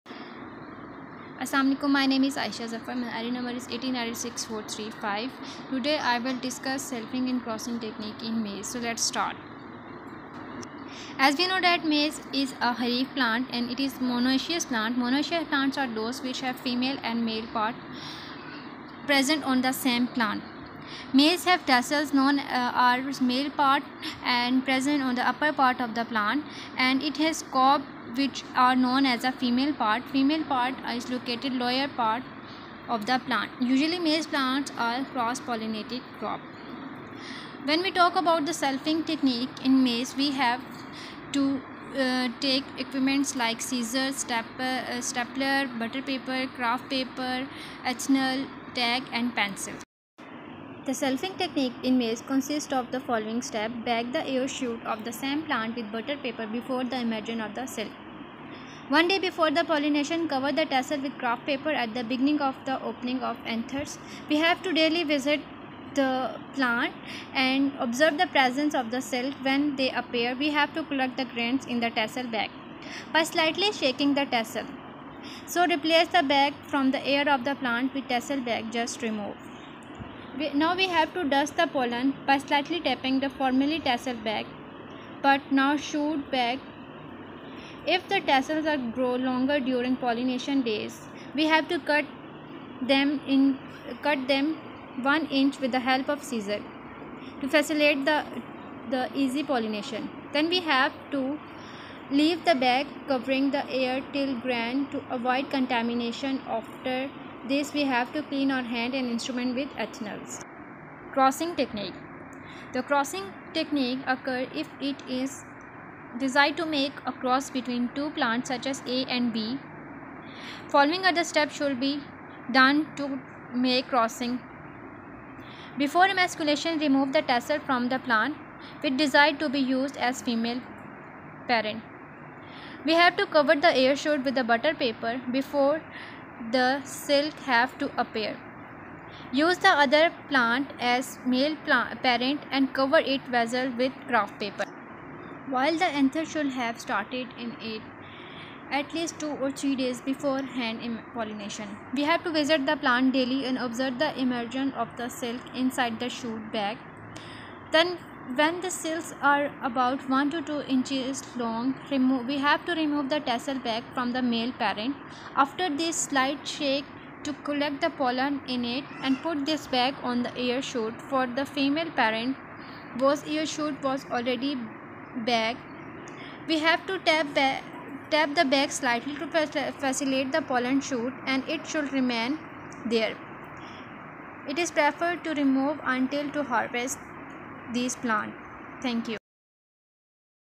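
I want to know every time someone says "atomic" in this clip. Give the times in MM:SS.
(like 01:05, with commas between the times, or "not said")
not said.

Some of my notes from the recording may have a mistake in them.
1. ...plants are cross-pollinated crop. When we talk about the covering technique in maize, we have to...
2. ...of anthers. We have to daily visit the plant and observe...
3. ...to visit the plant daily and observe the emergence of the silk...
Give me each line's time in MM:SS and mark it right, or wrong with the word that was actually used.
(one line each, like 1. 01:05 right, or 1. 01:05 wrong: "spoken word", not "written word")
1. 00:34 wrong: "selfing", not "covering"
2. 01:03 right
3. 02:32 right.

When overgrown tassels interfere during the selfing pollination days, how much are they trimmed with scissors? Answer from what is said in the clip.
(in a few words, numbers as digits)
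1 inch.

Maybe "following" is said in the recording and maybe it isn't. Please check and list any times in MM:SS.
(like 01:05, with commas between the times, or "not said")
00:52, 02:00.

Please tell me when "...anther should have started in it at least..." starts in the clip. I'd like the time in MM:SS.
02:25.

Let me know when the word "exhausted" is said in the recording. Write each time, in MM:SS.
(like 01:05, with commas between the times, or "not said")
not said.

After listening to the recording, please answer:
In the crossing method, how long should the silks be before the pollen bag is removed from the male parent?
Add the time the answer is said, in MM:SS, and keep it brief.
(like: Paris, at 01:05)
1 to 2 inches, at 02:40.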